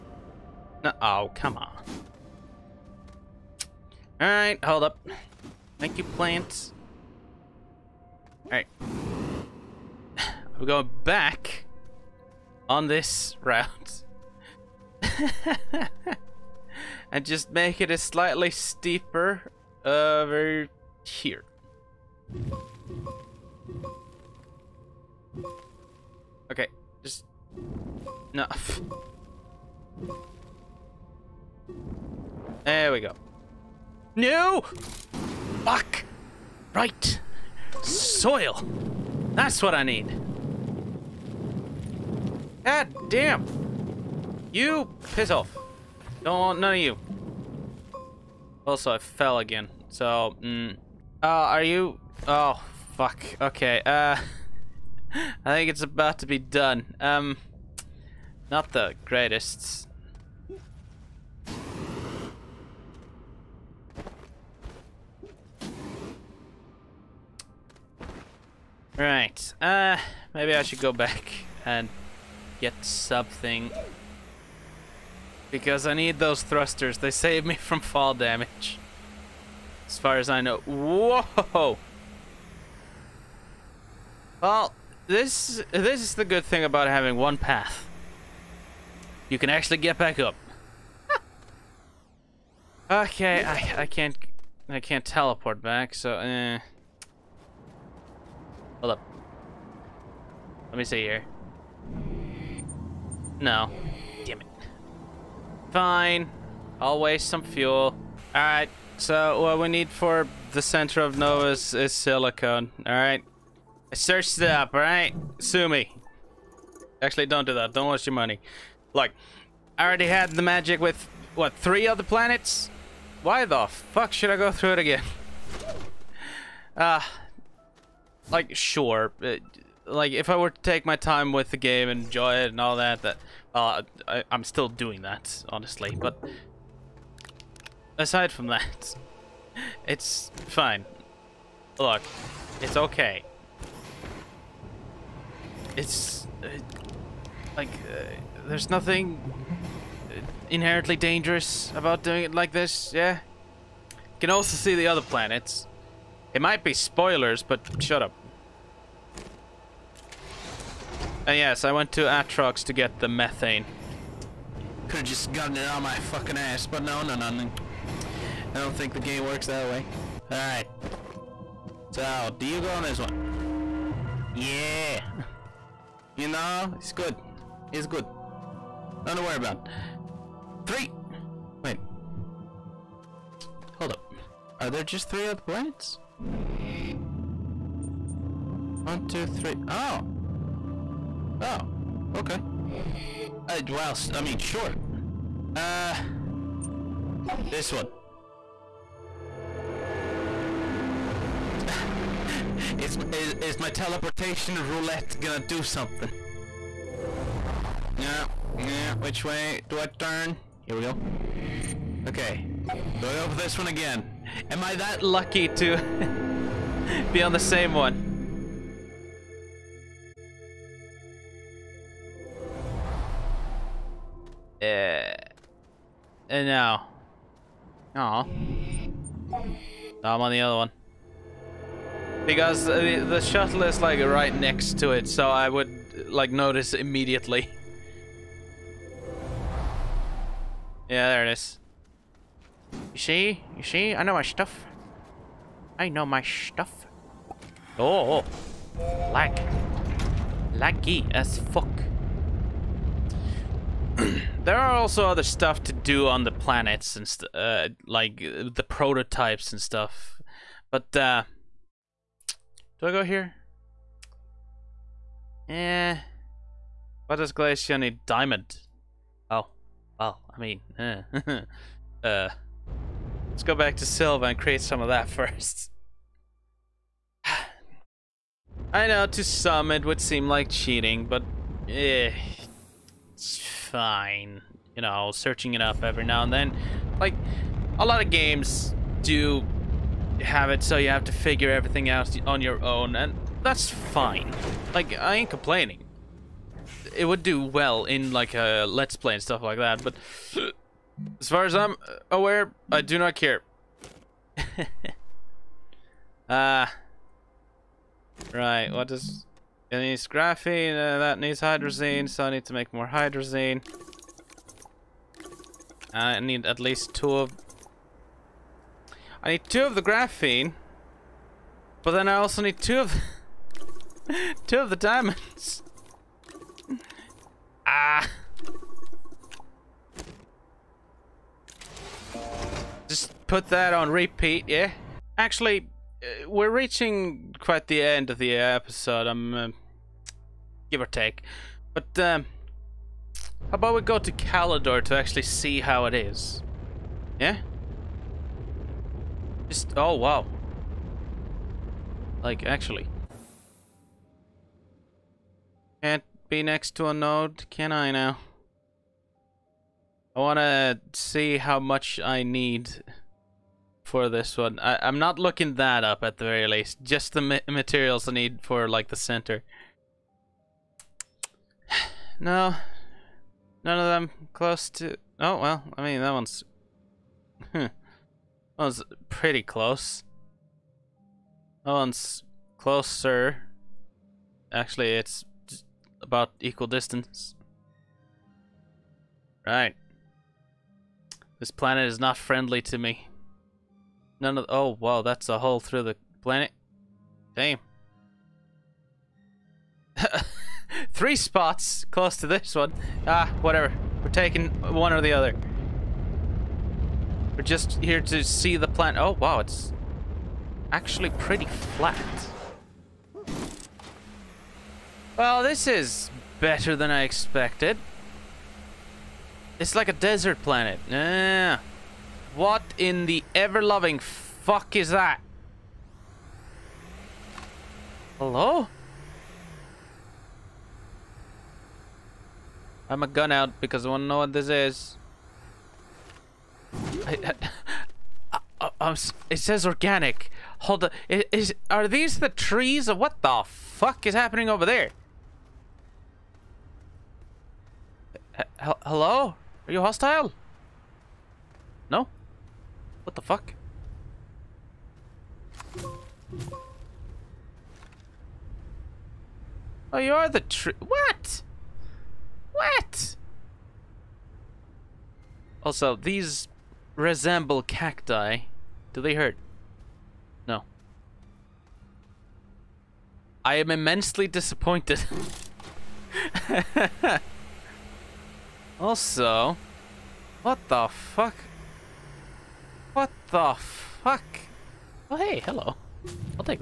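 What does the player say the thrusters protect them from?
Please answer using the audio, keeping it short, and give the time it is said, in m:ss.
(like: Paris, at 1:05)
Fall damage, at 1:17.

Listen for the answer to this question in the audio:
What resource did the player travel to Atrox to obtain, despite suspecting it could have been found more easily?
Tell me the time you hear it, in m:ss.
2:43.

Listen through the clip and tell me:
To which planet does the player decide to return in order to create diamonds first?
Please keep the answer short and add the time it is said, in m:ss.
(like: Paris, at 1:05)
Sylva, at 4:33.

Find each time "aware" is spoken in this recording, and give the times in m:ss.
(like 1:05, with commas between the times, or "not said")
5:02.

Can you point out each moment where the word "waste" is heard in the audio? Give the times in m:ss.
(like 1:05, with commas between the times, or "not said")
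1:47, 1:57.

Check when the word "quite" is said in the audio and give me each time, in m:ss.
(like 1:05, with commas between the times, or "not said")
5:37.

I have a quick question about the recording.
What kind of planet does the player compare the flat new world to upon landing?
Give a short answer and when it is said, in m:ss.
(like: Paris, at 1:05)
Desert planet, at 6:59.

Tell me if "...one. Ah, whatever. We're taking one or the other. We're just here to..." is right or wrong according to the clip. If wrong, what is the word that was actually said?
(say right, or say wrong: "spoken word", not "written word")
right.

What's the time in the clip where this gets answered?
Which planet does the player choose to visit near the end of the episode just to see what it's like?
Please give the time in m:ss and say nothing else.
5:44.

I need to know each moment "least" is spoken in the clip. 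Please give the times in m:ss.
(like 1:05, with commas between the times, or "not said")
5:16, 6:06.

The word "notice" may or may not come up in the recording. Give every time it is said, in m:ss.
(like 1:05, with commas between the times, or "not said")
3:56.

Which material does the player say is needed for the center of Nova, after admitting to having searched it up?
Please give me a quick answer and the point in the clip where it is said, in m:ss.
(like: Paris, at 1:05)
Silicone, at 1:51.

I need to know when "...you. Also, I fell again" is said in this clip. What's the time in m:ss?
0:46.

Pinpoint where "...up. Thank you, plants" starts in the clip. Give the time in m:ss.
0:04.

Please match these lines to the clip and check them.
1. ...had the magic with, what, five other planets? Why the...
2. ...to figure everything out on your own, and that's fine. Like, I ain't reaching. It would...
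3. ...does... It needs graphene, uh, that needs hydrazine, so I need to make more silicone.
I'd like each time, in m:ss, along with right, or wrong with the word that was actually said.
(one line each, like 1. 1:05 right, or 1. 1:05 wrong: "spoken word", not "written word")
1. 2:00 wrong: "three", not "five"
2. 4:51 wrong: "complaining", not "reaching"
3. 5:08 wrong: "hydrazine", not "silicone".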